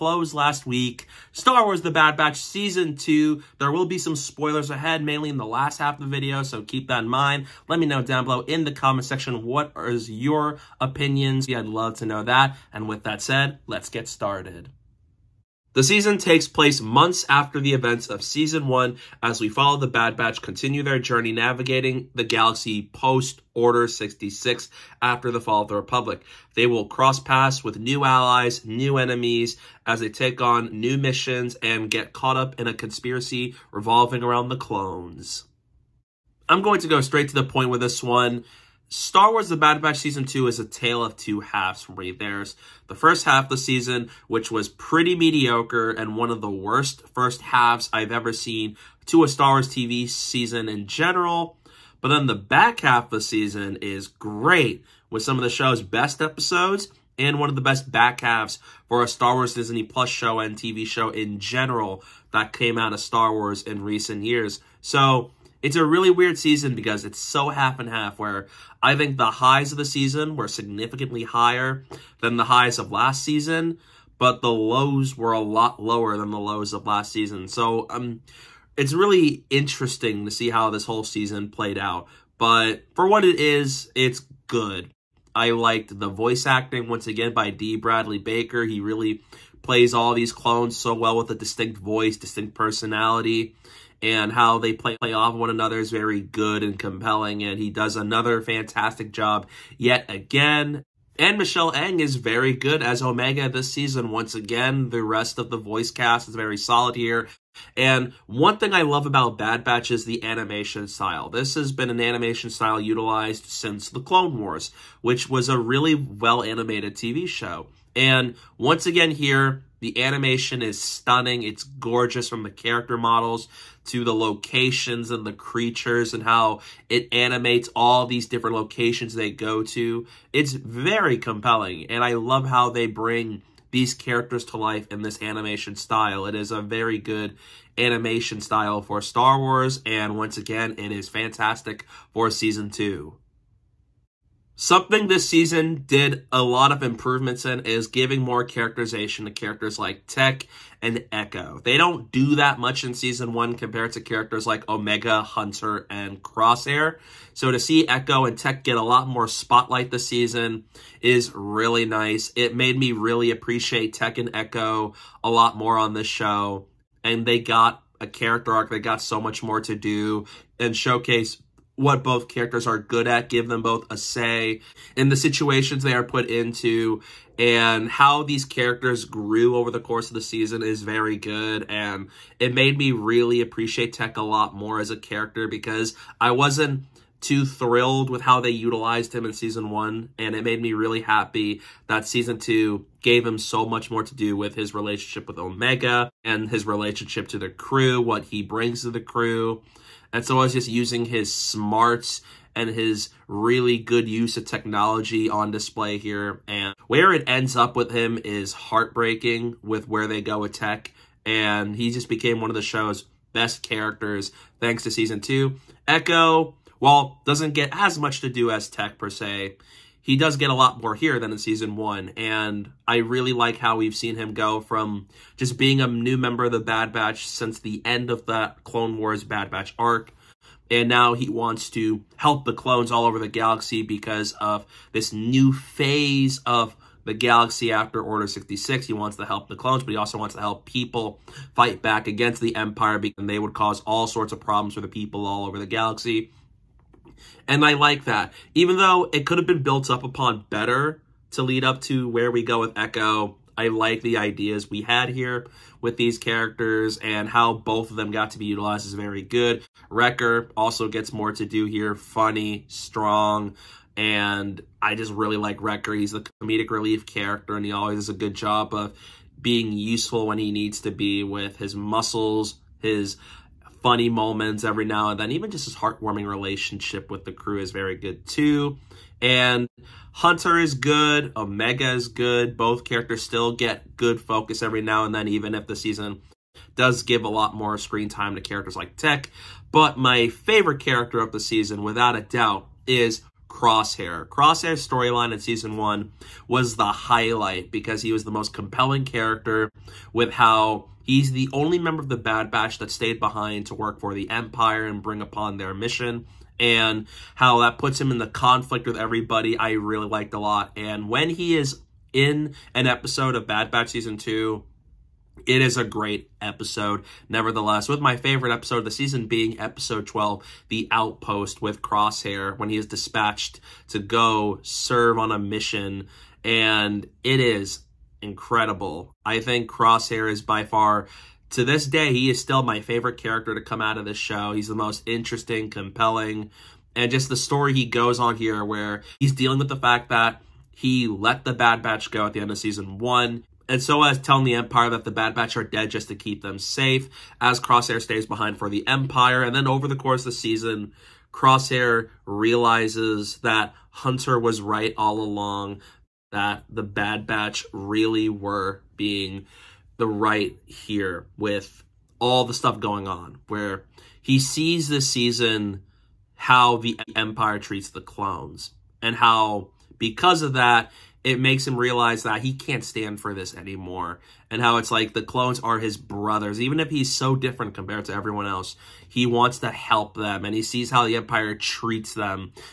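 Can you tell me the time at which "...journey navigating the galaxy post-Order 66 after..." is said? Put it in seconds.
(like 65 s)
20 s.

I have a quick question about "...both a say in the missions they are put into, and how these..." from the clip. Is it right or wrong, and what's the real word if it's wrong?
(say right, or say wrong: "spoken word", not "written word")
wrong: "situations", not "missions".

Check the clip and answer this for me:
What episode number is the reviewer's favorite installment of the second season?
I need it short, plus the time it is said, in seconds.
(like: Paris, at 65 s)
12, at 319 s.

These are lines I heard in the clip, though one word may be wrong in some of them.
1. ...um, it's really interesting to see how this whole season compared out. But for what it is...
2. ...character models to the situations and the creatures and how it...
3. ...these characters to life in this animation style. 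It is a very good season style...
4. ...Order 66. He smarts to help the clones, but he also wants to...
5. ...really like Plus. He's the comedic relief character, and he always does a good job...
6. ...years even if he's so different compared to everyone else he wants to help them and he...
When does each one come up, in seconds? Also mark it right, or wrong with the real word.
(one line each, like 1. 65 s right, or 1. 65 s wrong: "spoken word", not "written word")
1. 77 s wrong: "played", not "compared"
2. 122 s wrong: "locations", not "situations"
3. 133 s wrong: "animation", not "season"
4. 238 s wrong: "wants", not "smarts"
5. 265 s wrong: "Wrecker", not "Plus"
6. 375 s wrong: "brothers", not "years".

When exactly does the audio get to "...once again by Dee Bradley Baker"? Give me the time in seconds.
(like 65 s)
86 s.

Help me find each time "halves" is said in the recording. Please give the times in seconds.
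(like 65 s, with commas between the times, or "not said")
41 s, 47 s, 58 s.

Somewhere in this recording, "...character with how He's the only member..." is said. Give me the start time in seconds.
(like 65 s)
299 s.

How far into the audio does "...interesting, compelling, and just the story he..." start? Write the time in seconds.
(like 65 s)
335 s.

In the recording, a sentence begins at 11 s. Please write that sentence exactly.
Yeah, I'd love to know that.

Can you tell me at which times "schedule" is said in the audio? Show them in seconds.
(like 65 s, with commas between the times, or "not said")
not said.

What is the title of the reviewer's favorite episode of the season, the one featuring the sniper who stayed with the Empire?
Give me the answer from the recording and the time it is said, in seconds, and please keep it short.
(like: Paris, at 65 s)
The Outpost, at 320 s.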